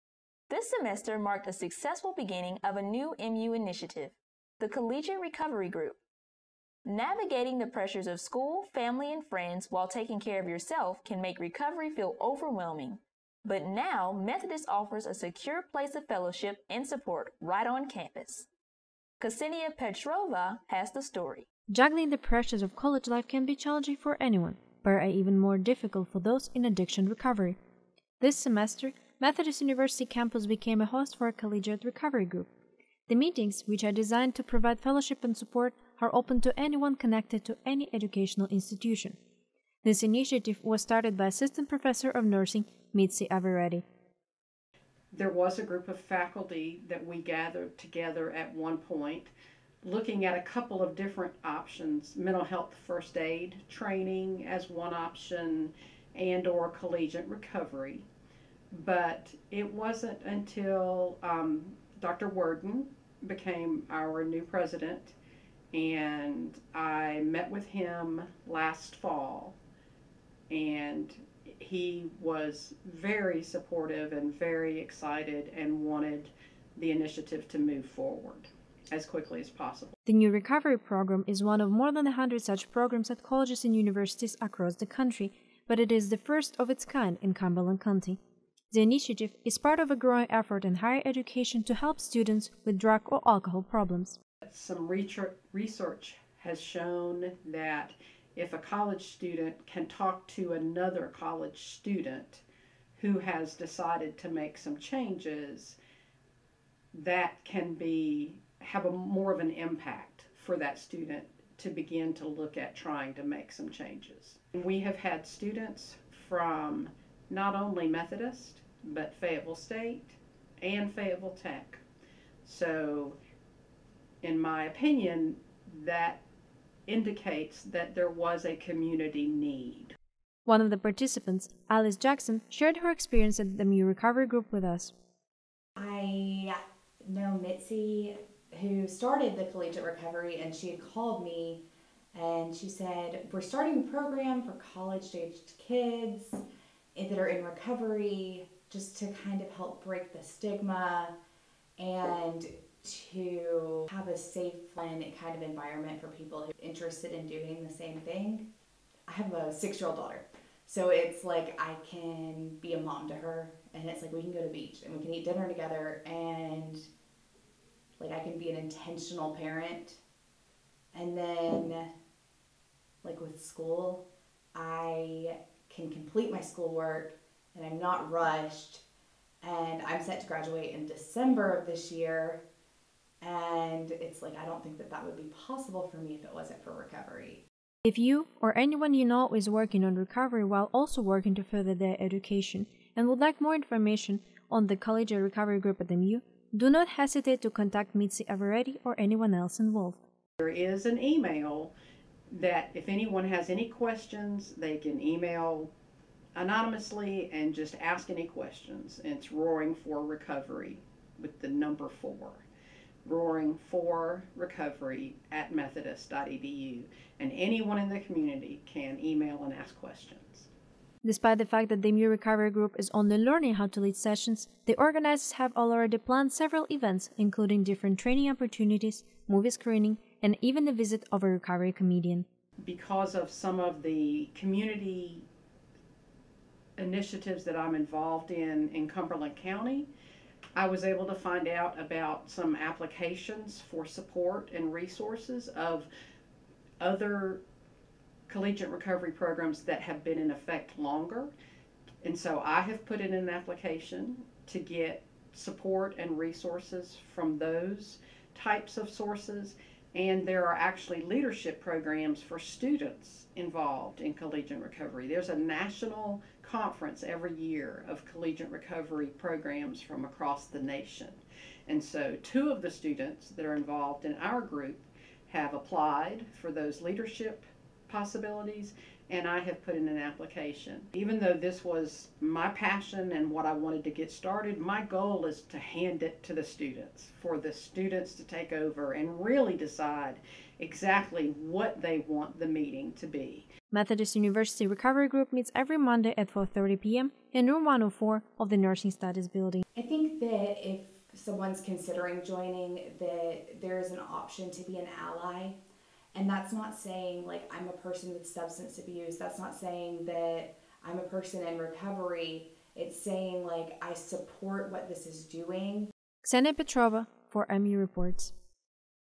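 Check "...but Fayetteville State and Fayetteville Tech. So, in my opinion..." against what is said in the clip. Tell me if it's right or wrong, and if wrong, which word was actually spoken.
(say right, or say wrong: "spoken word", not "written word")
right.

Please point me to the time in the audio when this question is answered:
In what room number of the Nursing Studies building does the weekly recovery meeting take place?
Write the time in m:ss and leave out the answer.
4:57.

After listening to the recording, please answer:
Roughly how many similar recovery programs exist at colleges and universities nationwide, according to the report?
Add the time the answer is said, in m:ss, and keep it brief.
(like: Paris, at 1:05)
more than 100, at 1:21.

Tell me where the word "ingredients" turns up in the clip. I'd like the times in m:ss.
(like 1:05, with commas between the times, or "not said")
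not said.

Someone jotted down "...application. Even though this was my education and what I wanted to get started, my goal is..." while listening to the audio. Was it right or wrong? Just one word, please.
wrong.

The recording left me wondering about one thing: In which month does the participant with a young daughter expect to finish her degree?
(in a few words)
December.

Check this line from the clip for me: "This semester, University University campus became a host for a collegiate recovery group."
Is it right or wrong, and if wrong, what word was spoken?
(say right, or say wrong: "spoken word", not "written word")
wrong: "Methodist", not "University".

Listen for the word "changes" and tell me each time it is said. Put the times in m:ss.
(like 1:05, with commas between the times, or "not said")
1:44, 1:53.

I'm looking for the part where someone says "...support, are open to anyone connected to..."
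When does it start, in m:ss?
0:35.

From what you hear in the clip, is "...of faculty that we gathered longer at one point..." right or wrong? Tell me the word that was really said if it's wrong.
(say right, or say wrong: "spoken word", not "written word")
wrong: "together", not "longer".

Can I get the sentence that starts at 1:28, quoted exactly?
The initiative is part of a growing effort in higher education to help students with drug or alcohol problems.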